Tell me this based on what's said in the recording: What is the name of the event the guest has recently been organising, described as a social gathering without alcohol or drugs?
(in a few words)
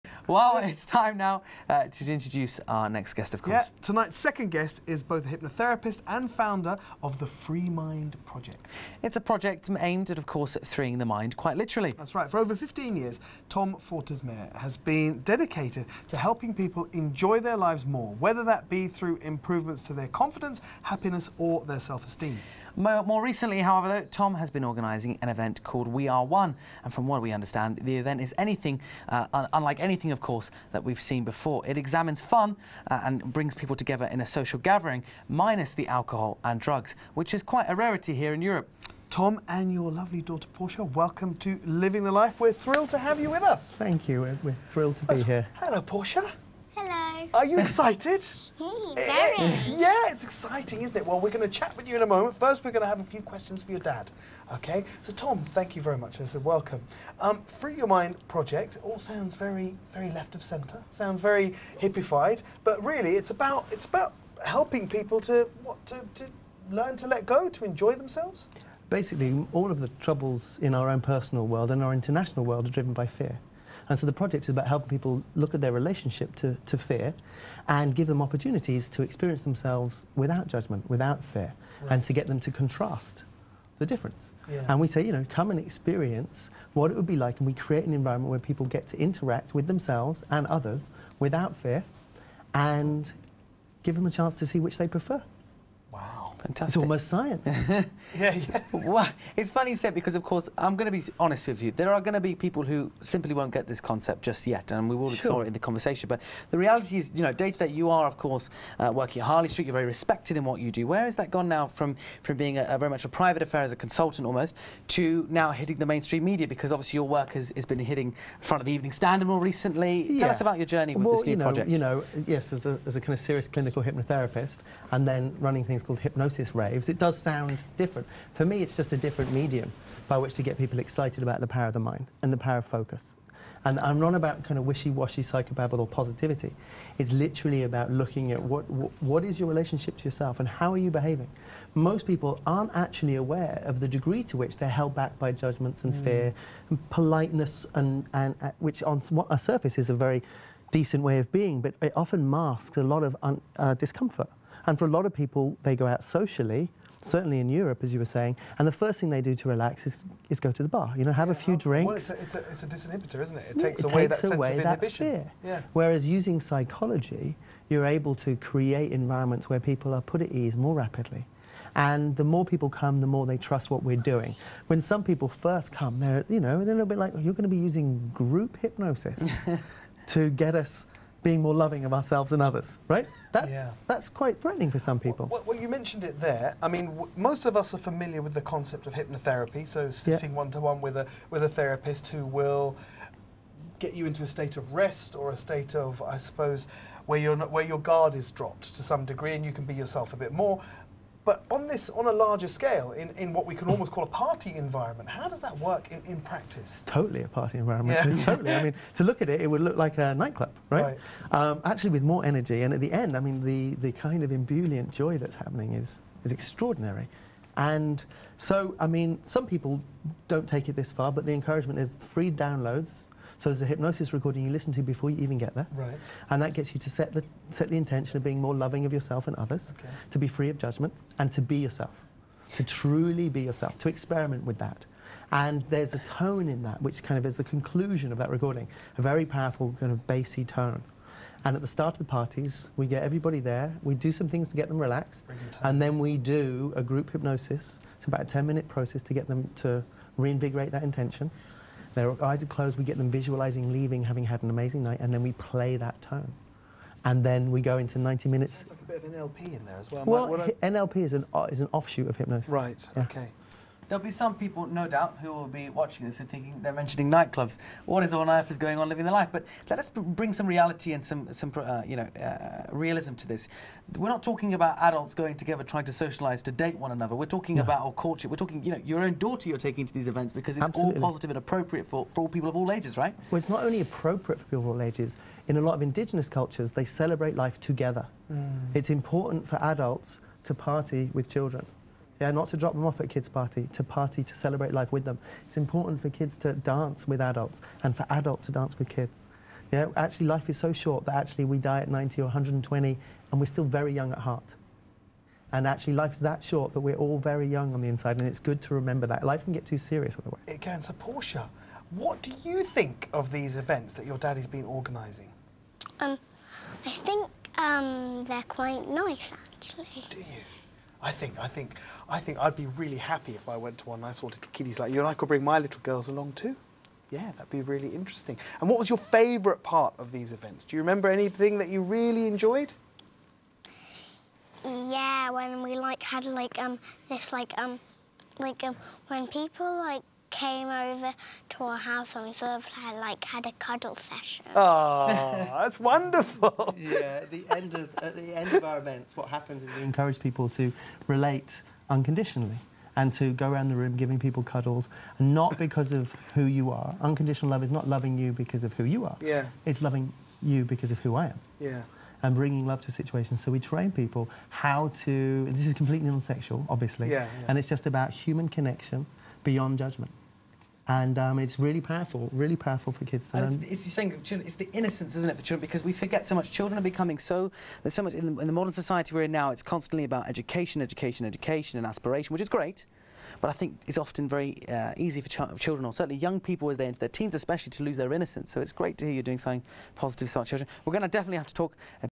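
We Are One.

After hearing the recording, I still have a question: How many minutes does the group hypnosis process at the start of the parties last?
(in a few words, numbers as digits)
10.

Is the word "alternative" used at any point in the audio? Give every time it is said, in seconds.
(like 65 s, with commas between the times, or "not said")
not said.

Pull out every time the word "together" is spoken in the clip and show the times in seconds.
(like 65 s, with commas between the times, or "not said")
33 s, 275 s, 287 s.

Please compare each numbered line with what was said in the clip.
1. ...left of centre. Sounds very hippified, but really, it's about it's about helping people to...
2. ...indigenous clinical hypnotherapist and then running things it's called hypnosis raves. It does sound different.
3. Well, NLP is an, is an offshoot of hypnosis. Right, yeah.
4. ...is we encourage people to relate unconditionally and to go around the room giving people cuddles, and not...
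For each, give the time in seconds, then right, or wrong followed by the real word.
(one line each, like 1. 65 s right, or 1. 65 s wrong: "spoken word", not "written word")
1. 60 s right
2. 123 s wrong: "serious", not "indigenous"
3. 260 s right
4. 349 s right.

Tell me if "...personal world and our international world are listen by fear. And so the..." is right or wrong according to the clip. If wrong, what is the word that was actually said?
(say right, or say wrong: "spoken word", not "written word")
wrong: "driven", not "listen".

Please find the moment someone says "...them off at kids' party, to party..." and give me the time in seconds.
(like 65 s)
292 s.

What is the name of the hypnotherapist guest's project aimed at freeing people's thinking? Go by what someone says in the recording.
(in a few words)
Free Mind Project.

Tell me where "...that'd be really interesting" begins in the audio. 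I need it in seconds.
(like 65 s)
327 s.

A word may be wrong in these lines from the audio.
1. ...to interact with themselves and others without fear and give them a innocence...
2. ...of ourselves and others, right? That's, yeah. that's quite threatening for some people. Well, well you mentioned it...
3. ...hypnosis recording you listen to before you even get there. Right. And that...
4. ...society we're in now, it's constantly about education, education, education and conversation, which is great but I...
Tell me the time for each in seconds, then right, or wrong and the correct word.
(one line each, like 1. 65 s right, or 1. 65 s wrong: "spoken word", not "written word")
1. 88 s wrong: "chance", not "innocence"
2. 181 s right
3. 223 s right
4. 378 s wrong: "aspiration", not "conversation".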